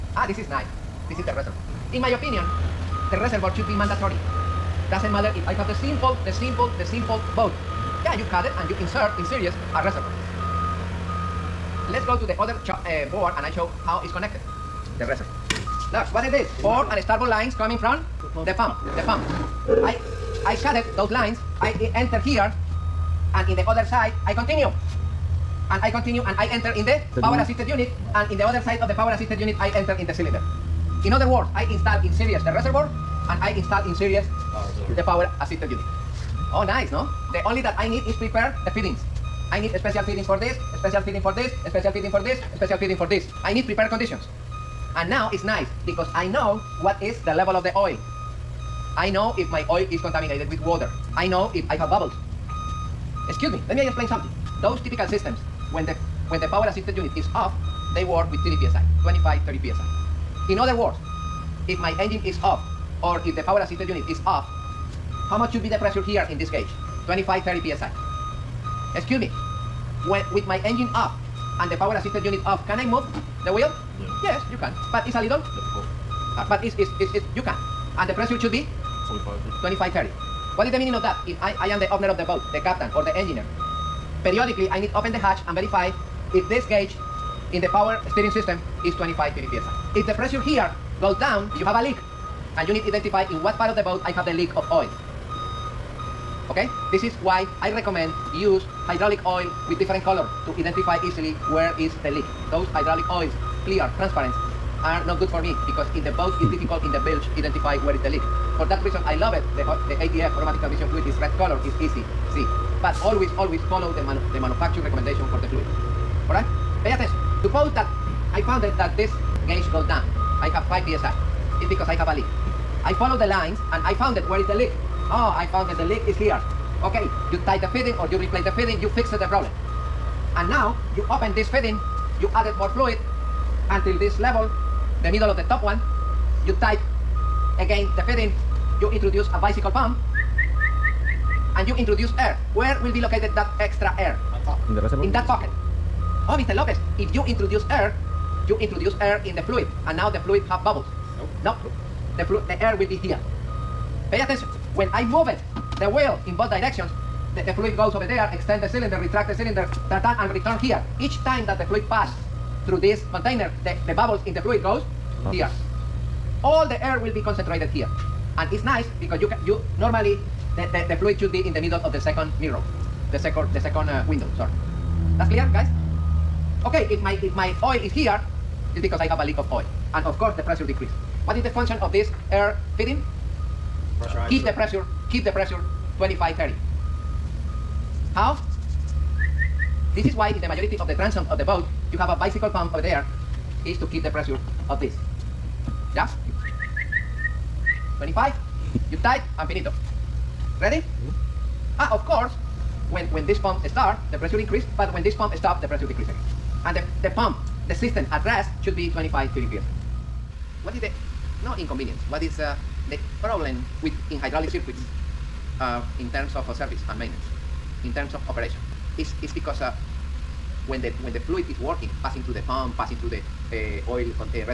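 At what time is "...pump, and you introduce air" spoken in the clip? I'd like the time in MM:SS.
02:19.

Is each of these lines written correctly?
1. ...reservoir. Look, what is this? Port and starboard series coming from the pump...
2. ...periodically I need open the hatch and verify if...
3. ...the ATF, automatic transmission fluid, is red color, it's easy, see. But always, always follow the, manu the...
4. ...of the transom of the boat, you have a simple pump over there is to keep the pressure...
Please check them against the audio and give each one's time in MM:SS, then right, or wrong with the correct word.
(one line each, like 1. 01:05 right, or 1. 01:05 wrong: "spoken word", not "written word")
1. 00:15 wrong: "lines", not "series"
2. 01:24 right
3. 01:49 right
4. 03:10 wrong: "bicycle", not "simple".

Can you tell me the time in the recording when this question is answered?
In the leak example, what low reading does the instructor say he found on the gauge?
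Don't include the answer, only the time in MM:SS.
02:00.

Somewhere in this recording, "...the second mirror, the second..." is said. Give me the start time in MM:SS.
02:51.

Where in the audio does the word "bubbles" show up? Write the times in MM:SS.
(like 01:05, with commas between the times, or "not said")
00:51, 02:30, 02:43.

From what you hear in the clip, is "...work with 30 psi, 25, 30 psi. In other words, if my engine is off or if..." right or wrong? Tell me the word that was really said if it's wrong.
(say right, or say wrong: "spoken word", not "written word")
right.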